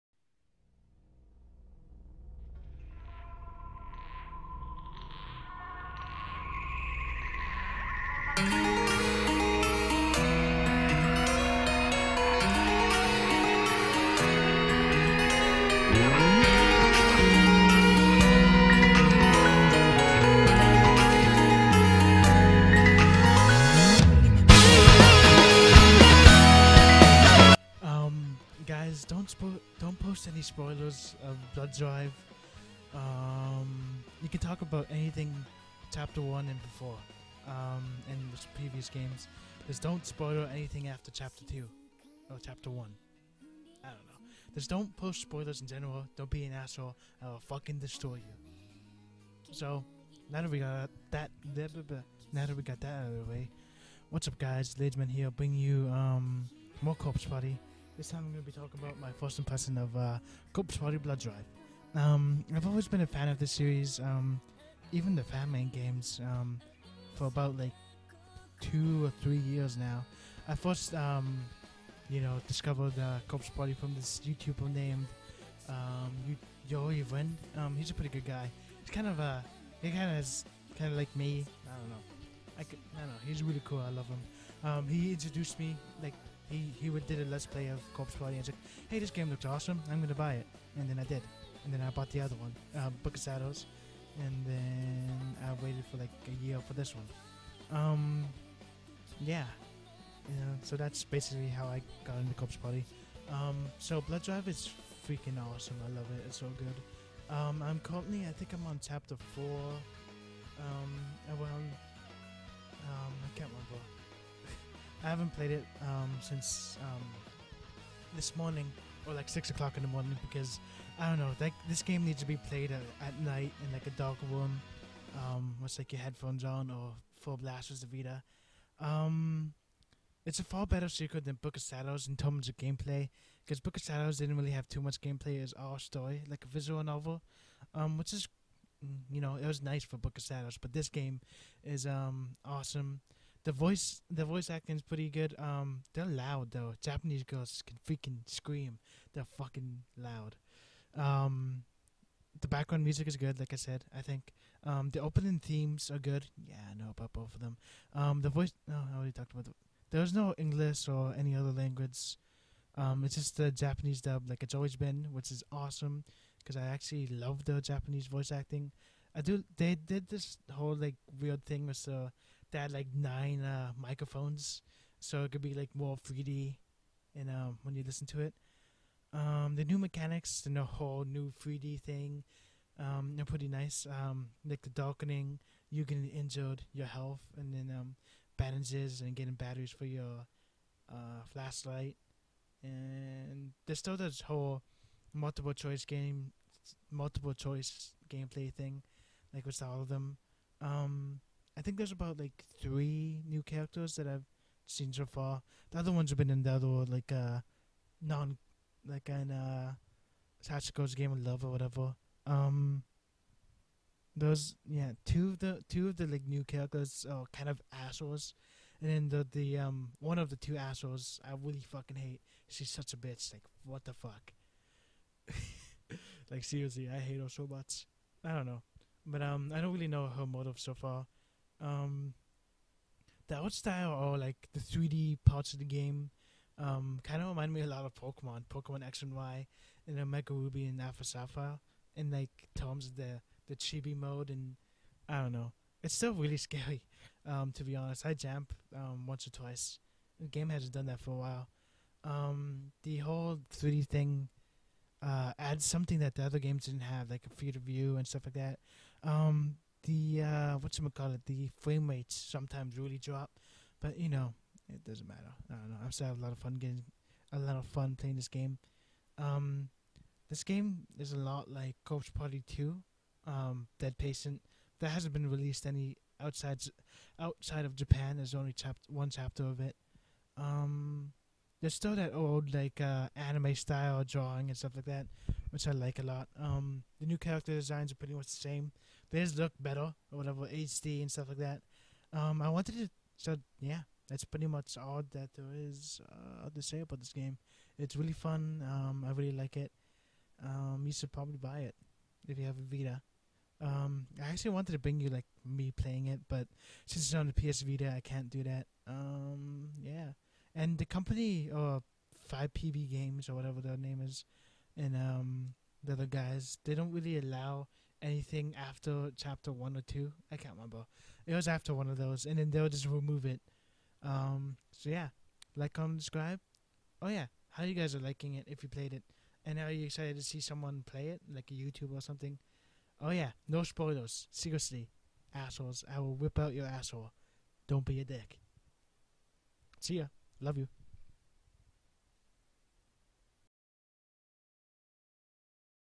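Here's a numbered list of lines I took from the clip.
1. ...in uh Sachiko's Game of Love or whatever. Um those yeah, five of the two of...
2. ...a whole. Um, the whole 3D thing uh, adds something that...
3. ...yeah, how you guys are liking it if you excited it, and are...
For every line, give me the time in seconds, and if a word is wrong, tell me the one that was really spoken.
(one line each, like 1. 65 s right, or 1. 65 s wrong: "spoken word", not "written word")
1. 209 s wrong: "two", not "five"
2. 251 s wrong: "while", not "whole"
3. 327 s wrong: "played", not "excited".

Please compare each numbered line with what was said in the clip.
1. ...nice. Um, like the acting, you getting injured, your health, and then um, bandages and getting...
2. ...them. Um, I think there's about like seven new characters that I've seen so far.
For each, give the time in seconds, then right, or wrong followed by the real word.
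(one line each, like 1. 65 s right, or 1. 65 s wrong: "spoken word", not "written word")
1. 183 s wrong: "darkening", not "acting"
2. 199 s wrong: "three", not "seven".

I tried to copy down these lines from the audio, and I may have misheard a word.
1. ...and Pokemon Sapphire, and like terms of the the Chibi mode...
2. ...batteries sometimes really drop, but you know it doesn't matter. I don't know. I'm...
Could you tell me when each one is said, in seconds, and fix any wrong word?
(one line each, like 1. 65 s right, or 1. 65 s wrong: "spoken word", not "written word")
1. 240 s wrong: "Alpha", not "Pokemon"
2. 261 s wrong: "rates", not "batteries".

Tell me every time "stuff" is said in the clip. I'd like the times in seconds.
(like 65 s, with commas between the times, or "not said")
258 s, 284 s, 291 s.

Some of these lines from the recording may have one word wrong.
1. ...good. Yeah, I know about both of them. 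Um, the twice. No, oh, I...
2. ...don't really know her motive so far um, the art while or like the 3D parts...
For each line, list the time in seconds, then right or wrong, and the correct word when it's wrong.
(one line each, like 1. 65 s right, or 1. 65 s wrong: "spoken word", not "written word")
1. 155 s wrong: "voice", not "twice"
2. 229 s wrong: "style", not "while".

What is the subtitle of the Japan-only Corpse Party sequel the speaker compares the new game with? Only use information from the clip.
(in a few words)
Dead Patient.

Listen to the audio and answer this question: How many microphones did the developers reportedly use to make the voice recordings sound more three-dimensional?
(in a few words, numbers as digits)
9.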